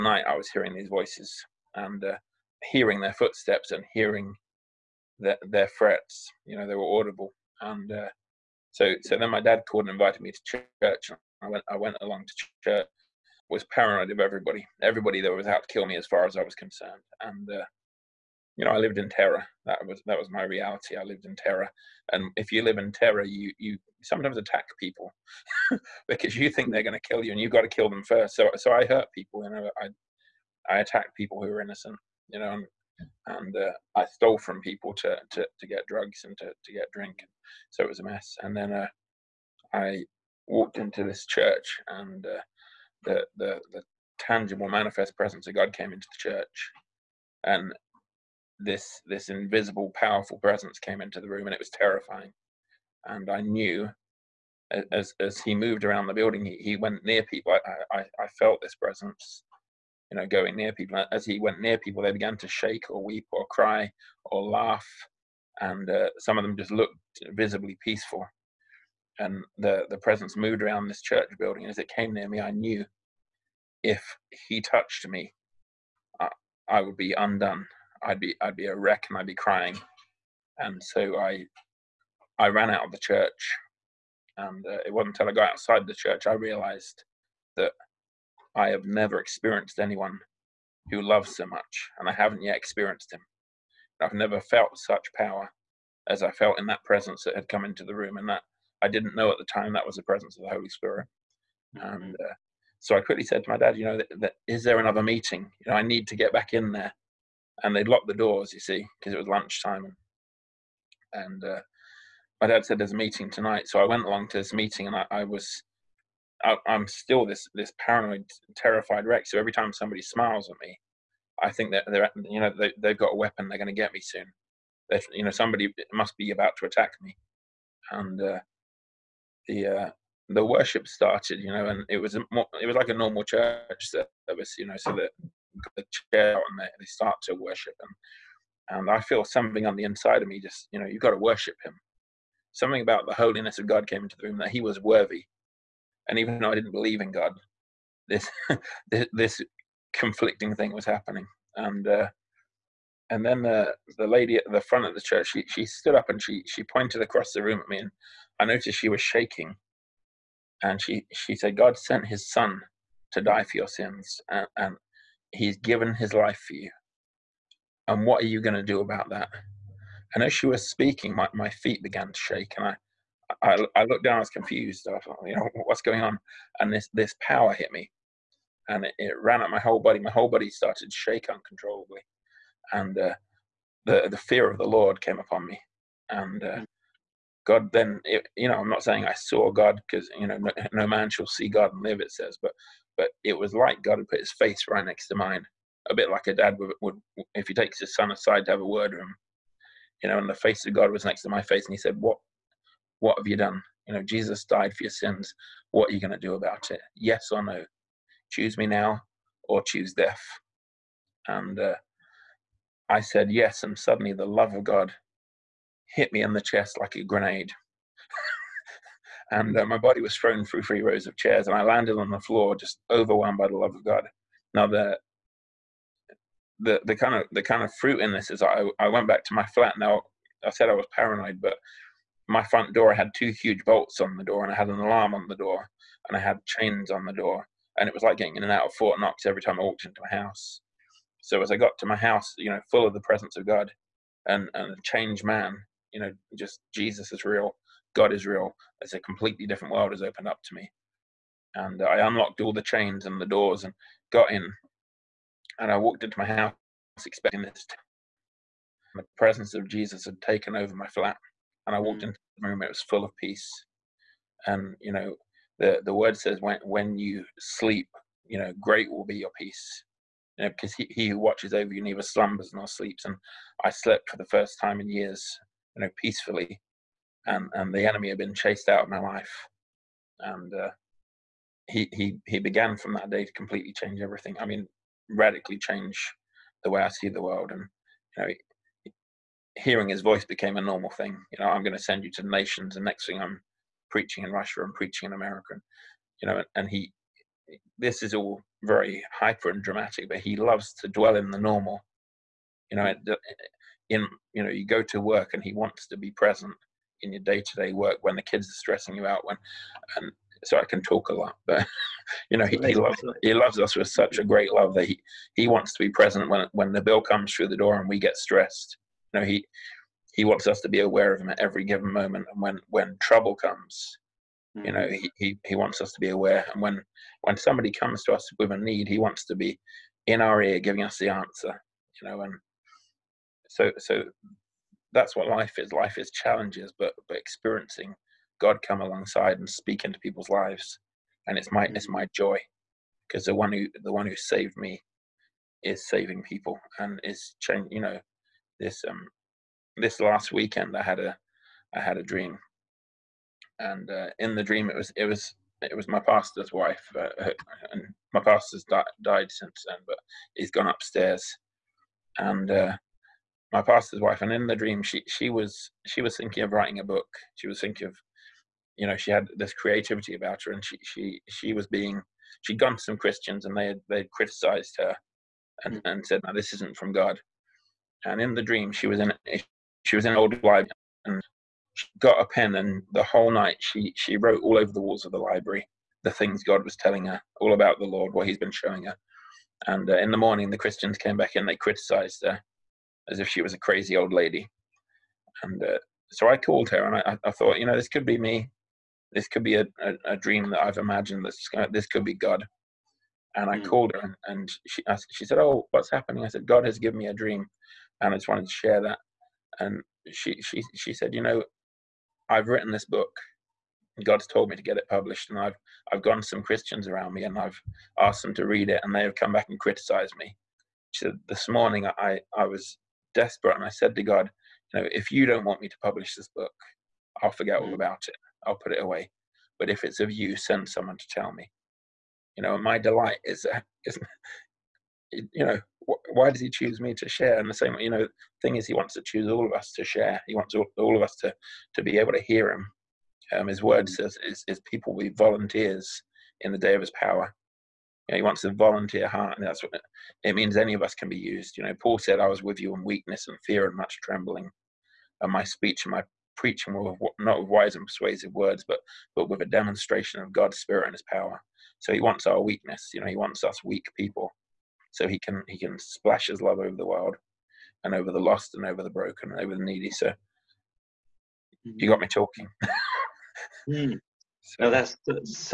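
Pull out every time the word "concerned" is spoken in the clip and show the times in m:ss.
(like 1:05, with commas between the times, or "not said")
0:16.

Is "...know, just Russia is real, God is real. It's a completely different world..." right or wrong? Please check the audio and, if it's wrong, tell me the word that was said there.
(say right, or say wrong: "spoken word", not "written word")
wrong: "Jesus", not "Russia".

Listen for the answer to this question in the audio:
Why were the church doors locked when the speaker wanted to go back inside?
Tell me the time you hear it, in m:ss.
1:49.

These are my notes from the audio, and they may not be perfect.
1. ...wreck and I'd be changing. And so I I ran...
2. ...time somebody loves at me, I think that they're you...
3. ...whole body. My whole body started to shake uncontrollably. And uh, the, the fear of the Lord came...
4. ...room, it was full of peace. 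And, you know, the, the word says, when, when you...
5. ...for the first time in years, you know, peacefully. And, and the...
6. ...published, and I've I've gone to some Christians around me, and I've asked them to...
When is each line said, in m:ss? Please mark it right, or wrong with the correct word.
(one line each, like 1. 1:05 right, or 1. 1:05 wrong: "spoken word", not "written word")
1. 1:18 wrong: "crying", not "changing"
2. 1:59 wrong: "smiles", not "loves"
3. 2:59 right
4. 4:22 right
5. 4:34 right
6. 6:54 right.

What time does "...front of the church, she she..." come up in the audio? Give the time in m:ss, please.
2:34.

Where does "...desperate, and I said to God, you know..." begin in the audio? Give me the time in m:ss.
7:03.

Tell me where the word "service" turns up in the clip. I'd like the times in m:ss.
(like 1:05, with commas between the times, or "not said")
2:13.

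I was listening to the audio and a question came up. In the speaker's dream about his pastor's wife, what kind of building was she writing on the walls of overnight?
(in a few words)
An old library.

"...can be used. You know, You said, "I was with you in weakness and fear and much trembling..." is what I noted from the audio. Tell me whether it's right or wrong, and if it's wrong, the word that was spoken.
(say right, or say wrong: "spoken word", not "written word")
wrong: "Paul", not "You".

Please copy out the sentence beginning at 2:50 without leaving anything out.
And as she was speaking, my, my feet began to shake, and I I, I looked down, I was confused.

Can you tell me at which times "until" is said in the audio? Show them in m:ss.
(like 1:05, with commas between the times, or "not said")
1:25.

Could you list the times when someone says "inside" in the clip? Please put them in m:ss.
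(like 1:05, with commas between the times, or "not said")
2:19.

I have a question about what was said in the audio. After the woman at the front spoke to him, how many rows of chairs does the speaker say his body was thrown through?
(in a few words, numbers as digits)
3.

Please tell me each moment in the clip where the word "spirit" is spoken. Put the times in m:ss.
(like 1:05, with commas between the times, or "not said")
1:40, 7:40.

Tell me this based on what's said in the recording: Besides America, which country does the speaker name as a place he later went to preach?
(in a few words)
Russia.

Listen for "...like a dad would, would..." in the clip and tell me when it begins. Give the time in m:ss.
3:16.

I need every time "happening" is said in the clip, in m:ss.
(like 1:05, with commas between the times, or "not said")
2:30, 6:45.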